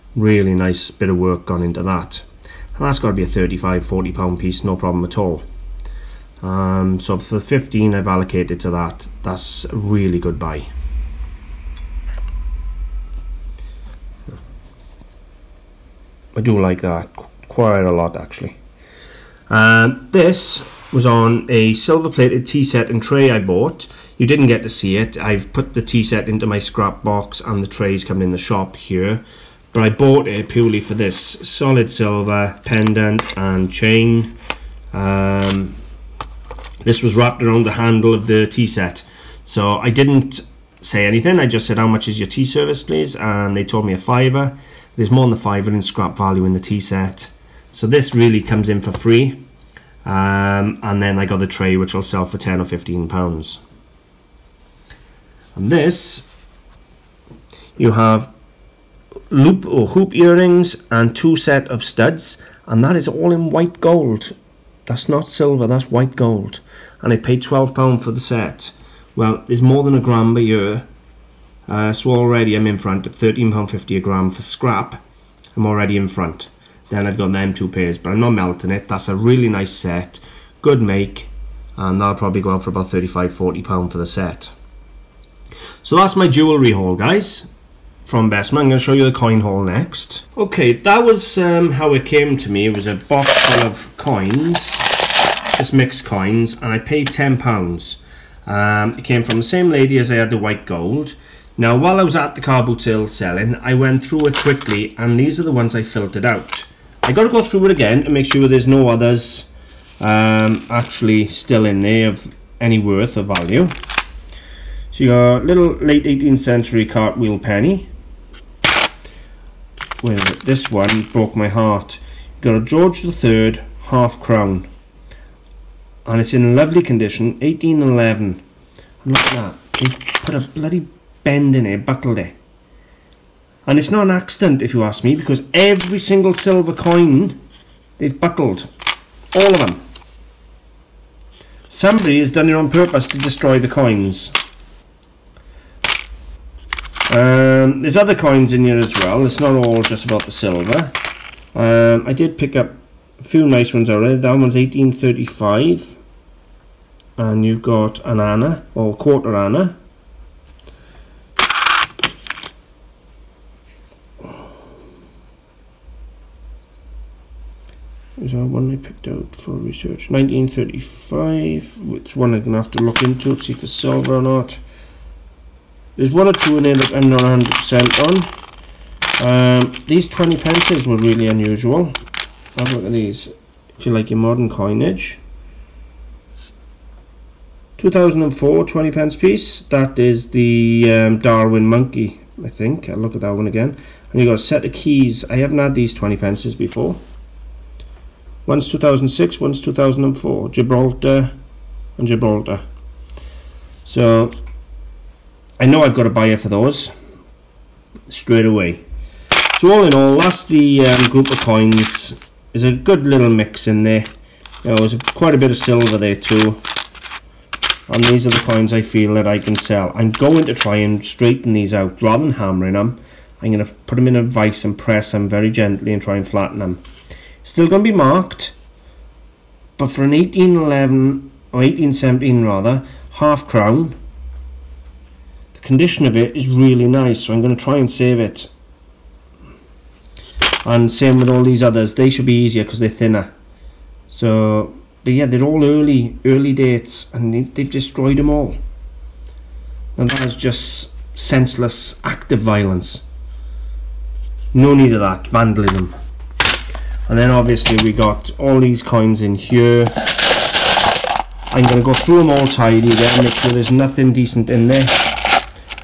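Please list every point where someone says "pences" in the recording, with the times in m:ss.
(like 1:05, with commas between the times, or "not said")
3:00, 3:08, 3:16.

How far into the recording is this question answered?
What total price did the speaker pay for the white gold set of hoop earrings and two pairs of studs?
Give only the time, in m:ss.
1:07.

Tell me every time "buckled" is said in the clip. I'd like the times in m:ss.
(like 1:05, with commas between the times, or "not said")
2:11, 2:18.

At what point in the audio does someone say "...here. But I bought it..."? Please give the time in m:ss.
0:28.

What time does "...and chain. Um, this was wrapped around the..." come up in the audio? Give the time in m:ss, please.
0:33.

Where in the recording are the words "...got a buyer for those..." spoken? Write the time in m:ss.
3:25.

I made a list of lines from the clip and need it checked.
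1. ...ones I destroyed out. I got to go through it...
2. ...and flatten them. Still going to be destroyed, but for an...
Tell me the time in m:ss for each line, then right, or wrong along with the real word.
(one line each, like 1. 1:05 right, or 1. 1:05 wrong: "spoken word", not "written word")
1. 1:45 wrong: "filtered", not "destroyed"
2. 3:46 wrong: "marked", not "destroyed".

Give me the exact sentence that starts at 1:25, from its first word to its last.
So that's my jewellery haul, guys, from Bessemer.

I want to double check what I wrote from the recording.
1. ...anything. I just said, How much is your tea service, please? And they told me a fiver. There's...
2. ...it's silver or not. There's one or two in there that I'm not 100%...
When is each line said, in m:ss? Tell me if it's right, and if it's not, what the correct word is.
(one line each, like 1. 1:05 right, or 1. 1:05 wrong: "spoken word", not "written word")
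1. 0:41 right
2. 2:53 right.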